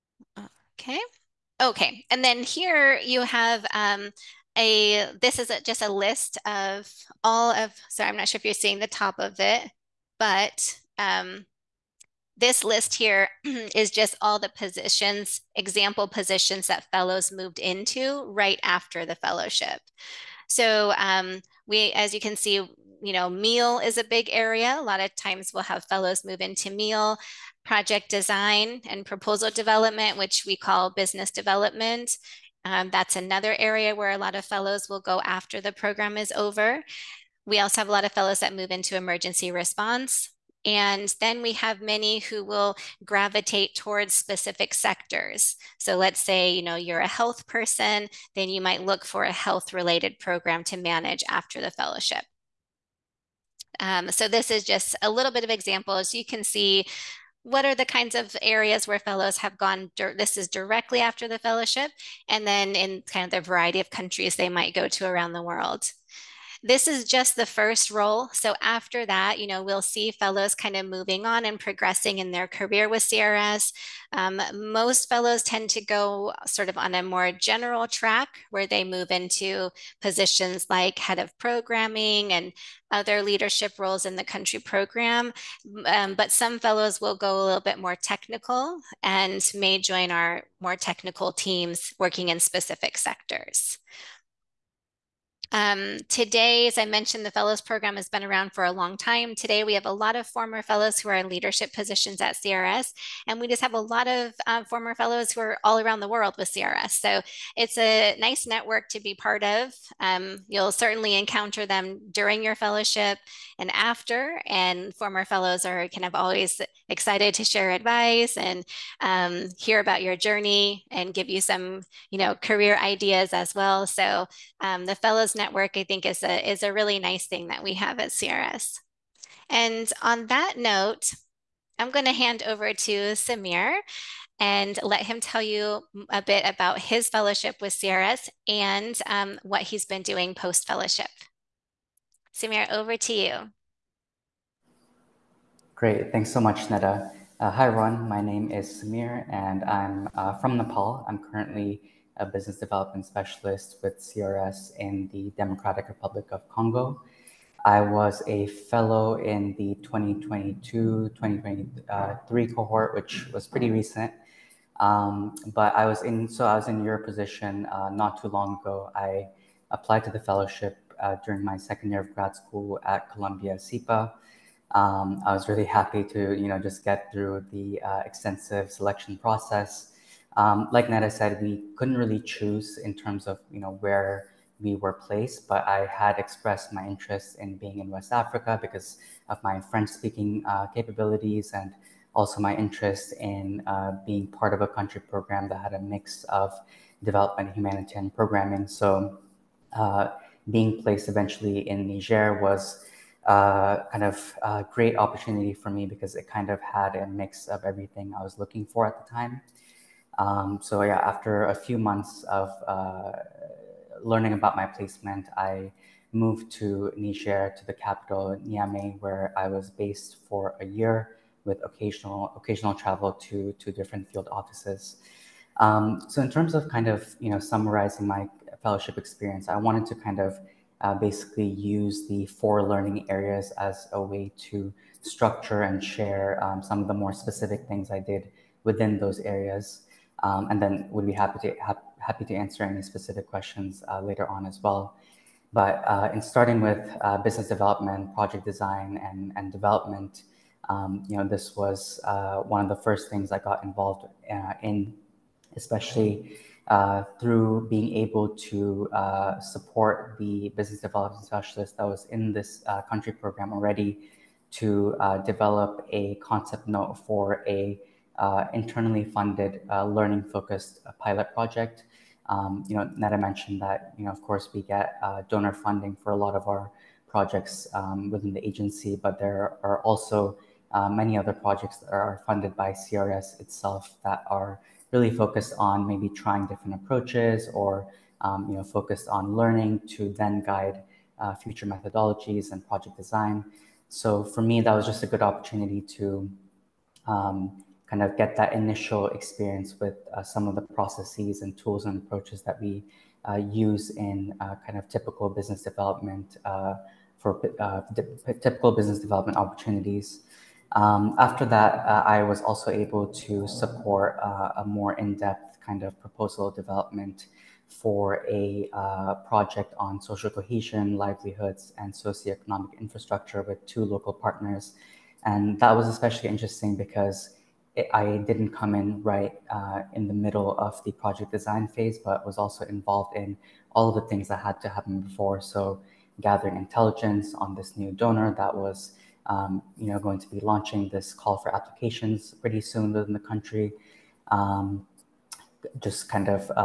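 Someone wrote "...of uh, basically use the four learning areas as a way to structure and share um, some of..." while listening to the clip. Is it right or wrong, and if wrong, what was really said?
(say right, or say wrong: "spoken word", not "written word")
right.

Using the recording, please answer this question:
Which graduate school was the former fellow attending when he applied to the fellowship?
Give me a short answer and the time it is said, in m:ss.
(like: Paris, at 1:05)
Columbia SIPA, at 2:53.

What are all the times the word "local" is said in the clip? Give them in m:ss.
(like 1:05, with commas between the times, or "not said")
5:23.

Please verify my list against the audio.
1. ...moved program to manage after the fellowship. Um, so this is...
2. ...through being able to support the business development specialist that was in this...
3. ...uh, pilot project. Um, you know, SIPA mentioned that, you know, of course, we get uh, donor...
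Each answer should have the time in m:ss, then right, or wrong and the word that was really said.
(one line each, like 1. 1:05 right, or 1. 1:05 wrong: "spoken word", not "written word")
1. 0:49 wrong: "related", not "moved"
2. 4:17 right
3. 4:30 wrong: "Neta", not "SIPA".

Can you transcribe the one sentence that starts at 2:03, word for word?
So um, the Fellows network, I think, is a, is a really nice thing that we have at CRS.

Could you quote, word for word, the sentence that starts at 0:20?
So um, we, as you can see, you know, meal is a big area.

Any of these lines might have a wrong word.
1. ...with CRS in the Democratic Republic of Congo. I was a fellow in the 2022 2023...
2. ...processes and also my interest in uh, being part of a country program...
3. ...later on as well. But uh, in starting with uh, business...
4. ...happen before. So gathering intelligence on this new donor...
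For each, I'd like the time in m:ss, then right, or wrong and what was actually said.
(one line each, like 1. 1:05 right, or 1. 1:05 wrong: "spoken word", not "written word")
1. 2:33 right
2. 3:10 wrong: "capabilities", not "processes"
3. 4:04 right
4. 5:34 right.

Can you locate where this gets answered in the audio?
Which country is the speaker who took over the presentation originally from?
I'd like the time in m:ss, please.
2:30.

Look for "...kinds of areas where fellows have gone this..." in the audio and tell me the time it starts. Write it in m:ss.
0:57.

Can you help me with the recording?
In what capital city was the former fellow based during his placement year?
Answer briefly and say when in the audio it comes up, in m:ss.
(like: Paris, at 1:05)
Niamey, at 3:38.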